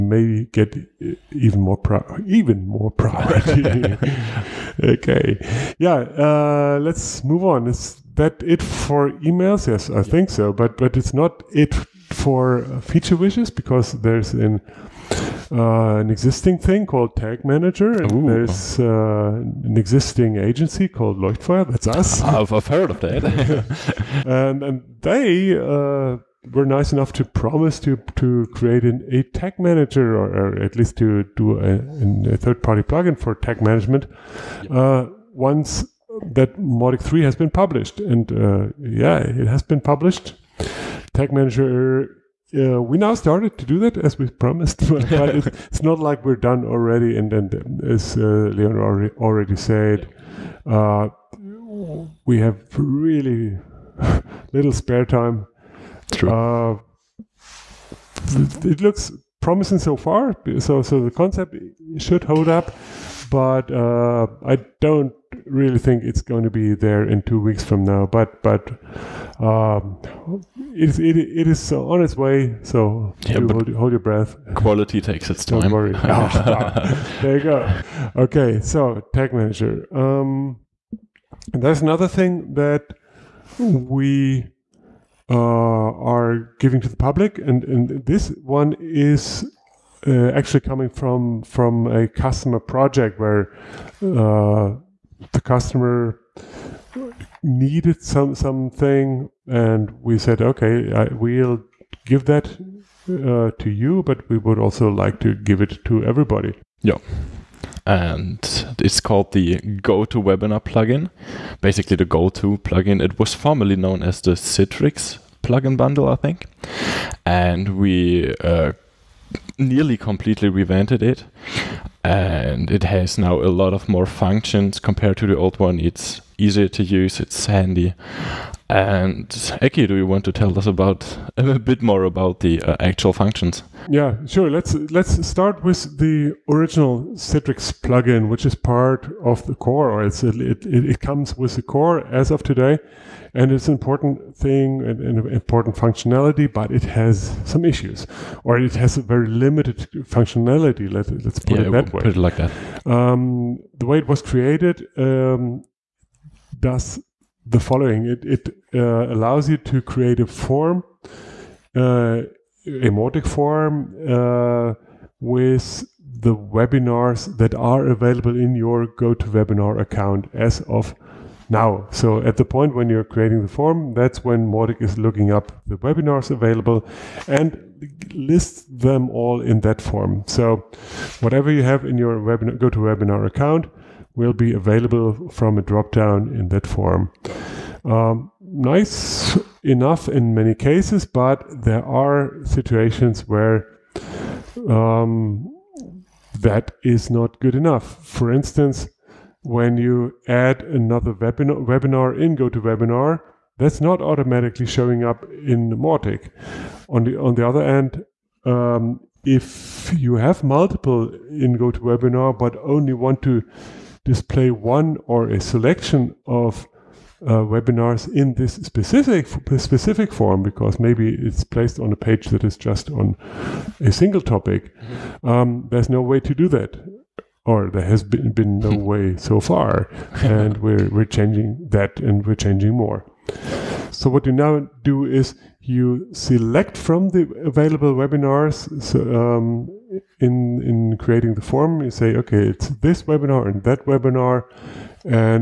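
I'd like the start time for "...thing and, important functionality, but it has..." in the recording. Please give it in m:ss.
2:24.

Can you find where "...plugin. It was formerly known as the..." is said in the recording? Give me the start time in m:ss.
1:52.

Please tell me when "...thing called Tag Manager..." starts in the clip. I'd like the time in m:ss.
0:16.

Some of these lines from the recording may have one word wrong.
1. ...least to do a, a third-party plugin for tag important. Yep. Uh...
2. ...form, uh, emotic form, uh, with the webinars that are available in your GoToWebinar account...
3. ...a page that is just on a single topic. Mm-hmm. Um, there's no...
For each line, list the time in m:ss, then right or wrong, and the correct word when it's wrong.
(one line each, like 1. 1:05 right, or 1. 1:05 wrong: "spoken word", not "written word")
1. 0:30 wrong: "management", not "important"
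2. 2:40 right
3. 3:41 right.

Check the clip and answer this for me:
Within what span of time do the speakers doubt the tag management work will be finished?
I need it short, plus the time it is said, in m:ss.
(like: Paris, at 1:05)
two weeks, at 1:07.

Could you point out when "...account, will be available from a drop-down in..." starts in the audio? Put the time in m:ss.
3:03.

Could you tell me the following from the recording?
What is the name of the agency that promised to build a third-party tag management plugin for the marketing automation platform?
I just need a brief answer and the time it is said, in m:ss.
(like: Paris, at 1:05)
Leuchtfeuer, at 0:21.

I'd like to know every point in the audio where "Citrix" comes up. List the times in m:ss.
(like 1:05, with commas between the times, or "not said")
1:54, 2:17.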